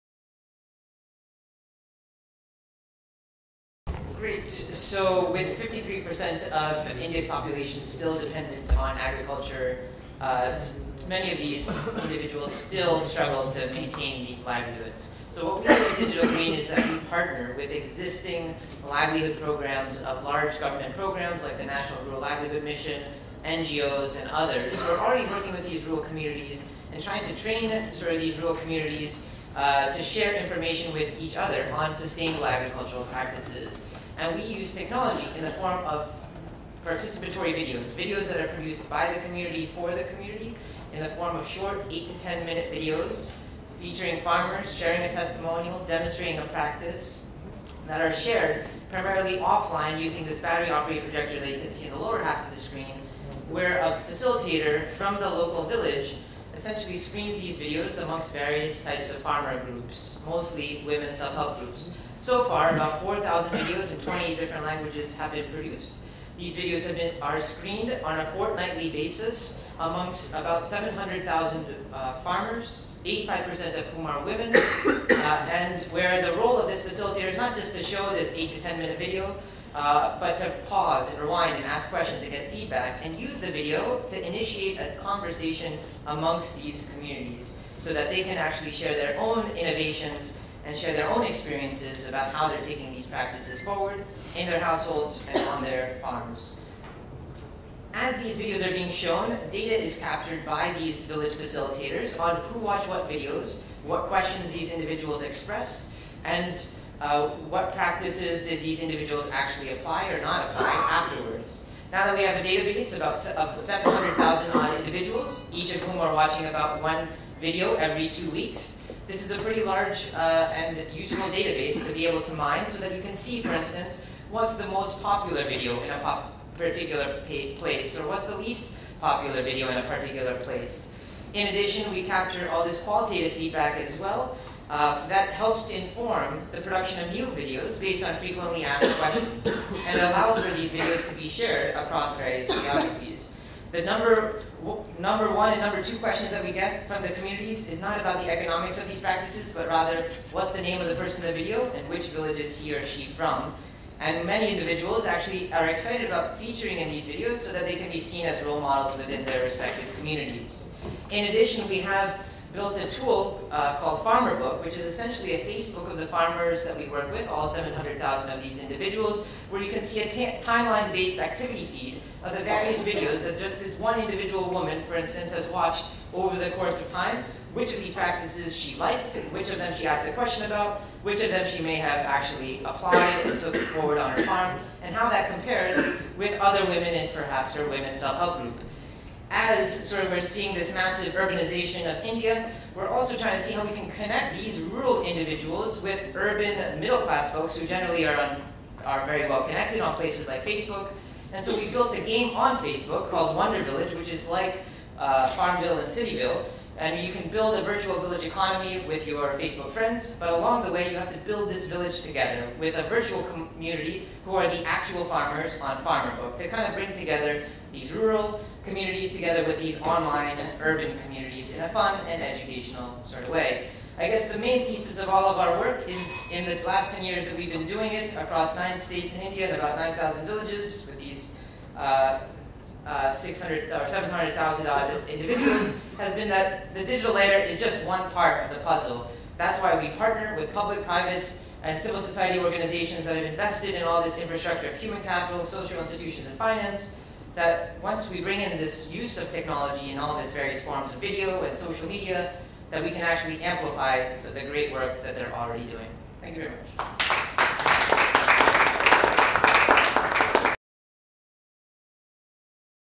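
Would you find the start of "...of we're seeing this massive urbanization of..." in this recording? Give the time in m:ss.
3:10.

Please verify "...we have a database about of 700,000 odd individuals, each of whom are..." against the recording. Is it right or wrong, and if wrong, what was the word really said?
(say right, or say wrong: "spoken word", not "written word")
right.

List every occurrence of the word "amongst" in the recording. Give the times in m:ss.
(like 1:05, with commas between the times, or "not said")
0:58, 1:09, 1:26.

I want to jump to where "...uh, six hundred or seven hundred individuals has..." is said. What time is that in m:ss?
3:52.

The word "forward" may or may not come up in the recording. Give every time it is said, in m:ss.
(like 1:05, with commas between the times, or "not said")
1:33, 3:03.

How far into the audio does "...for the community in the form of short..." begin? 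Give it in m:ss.
0:39.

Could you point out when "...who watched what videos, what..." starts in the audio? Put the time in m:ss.
1:42.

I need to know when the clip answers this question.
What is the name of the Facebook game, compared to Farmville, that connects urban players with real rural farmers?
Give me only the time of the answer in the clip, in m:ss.
3:23.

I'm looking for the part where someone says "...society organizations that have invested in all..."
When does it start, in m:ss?
4:02.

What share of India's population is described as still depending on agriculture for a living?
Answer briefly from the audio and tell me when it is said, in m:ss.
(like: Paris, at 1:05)
53%, at 0:05.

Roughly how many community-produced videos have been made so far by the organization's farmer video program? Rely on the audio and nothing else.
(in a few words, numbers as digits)
4,000.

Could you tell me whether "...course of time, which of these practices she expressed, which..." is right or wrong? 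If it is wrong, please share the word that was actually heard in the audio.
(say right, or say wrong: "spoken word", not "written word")
wrong: "liked", not "expressed".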